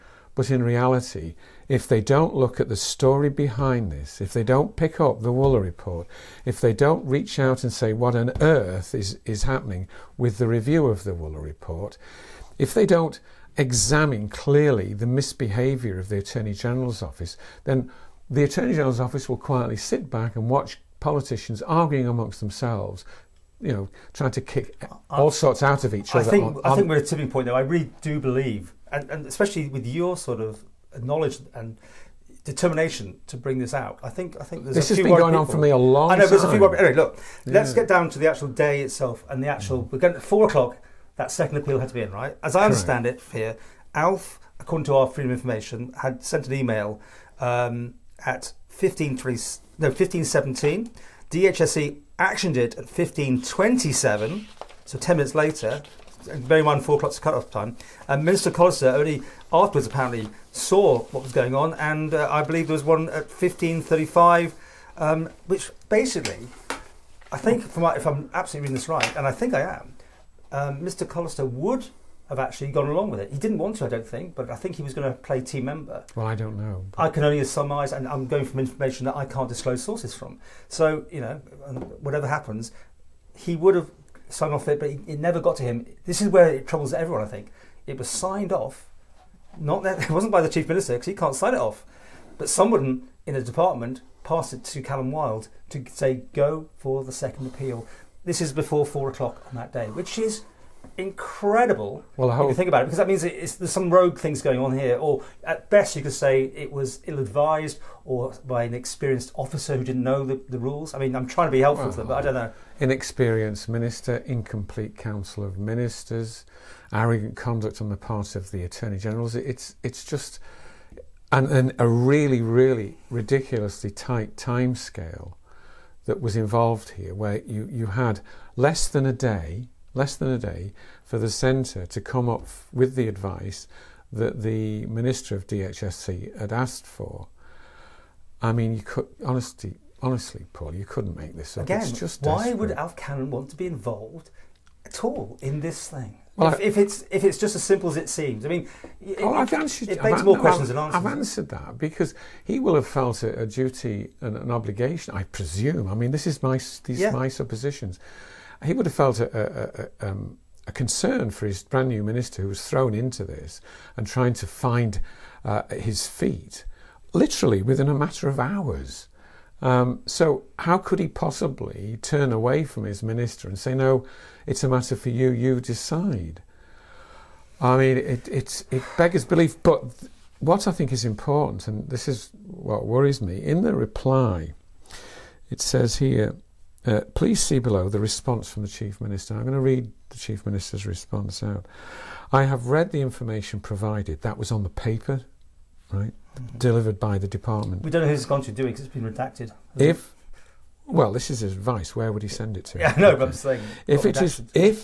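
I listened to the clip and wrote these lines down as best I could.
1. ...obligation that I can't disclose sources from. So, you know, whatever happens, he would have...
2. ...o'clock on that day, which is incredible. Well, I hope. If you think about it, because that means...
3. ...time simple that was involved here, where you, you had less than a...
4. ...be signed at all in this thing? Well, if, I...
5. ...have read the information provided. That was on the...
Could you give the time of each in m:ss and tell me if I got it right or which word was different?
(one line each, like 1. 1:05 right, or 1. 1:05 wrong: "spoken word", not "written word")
1. 1:18 wrong: "information", not "obligation"
2. 1:39 right
3. 2:04 wrong: "scale", not "simple"
4. 2:23 wrong: "involved", not "signed"
5. 3:12 right.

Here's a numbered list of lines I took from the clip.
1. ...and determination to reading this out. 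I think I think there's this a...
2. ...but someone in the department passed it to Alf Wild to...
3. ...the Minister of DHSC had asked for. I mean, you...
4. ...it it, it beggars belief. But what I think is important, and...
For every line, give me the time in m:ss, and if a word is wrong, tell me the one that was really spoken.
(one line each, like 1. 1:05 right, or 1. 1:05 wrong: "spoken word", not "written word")
1. 0:31 wrong: "bring", not "reading"
2. 1:32 wrong: "Callin", not "Alf"
3. 2:14 right
4. 2:57 right.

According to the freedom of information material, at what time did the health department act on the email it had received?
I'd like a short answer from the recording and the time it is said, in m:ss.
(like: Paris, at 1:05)
15:27, at 0:52.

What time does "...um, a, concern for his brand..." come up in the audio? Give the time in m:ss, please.
2:40.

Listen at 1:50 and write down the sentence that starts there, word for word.
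I mean, I'm trying to be helpful well, to them, but I don't know.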